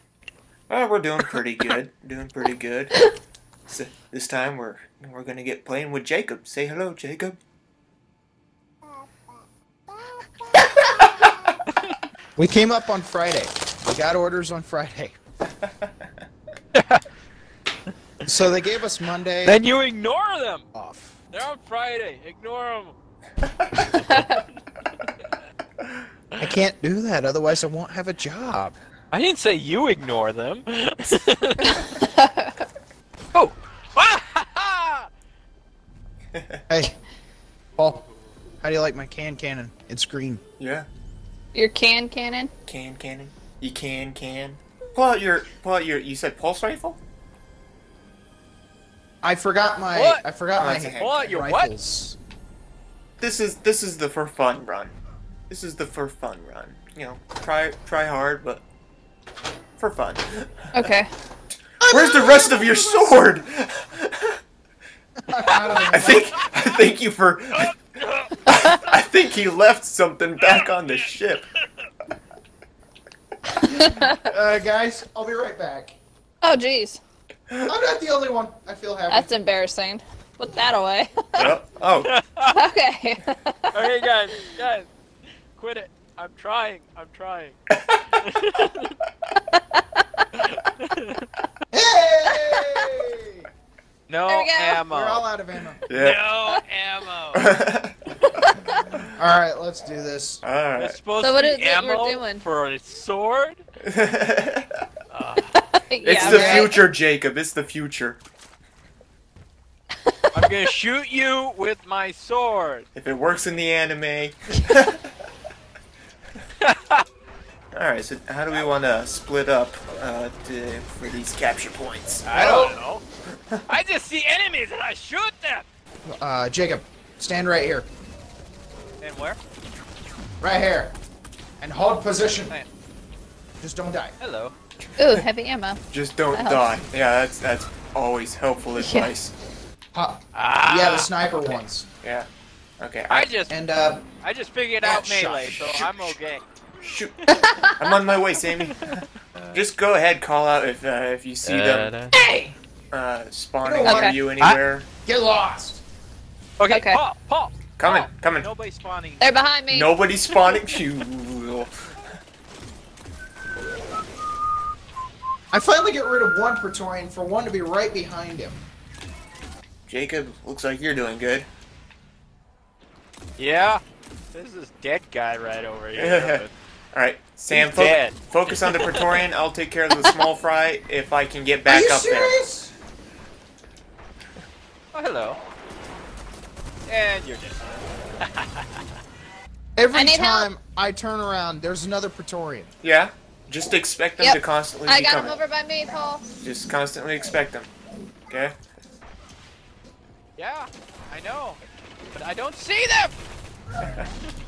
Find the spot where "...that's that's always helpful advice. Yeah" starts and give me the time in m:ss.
2:17.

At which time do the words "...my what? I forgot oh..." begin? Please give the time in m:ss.
0:49.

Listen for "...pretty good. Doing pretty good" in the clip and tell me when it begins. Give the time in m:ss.
0:01.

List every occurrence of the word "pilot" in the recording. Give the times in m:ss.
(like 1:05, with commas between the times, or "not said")
not said.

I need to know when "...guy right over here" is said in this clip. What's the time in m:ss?
2:55.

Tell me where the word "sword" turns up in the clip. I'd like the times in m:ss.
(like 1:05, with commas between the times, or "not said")
1:02, 1:42, 1:52.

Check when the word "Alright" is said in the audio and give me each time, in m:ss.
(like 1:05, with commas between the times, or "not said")
1:57, 2:56.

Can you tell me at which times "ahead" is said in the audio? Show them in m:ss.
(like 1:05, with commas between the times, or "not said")
2:29.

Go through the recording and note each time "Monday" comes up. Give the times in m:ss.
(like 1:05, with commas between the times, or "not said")
0:18.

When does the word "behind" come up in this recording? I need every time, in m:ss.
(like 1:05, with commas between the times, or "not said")
2:39, 2:47.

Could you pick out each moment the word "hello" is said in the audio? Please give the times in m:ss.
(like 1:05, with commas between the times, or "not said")
0:06, 2:14, 3:05.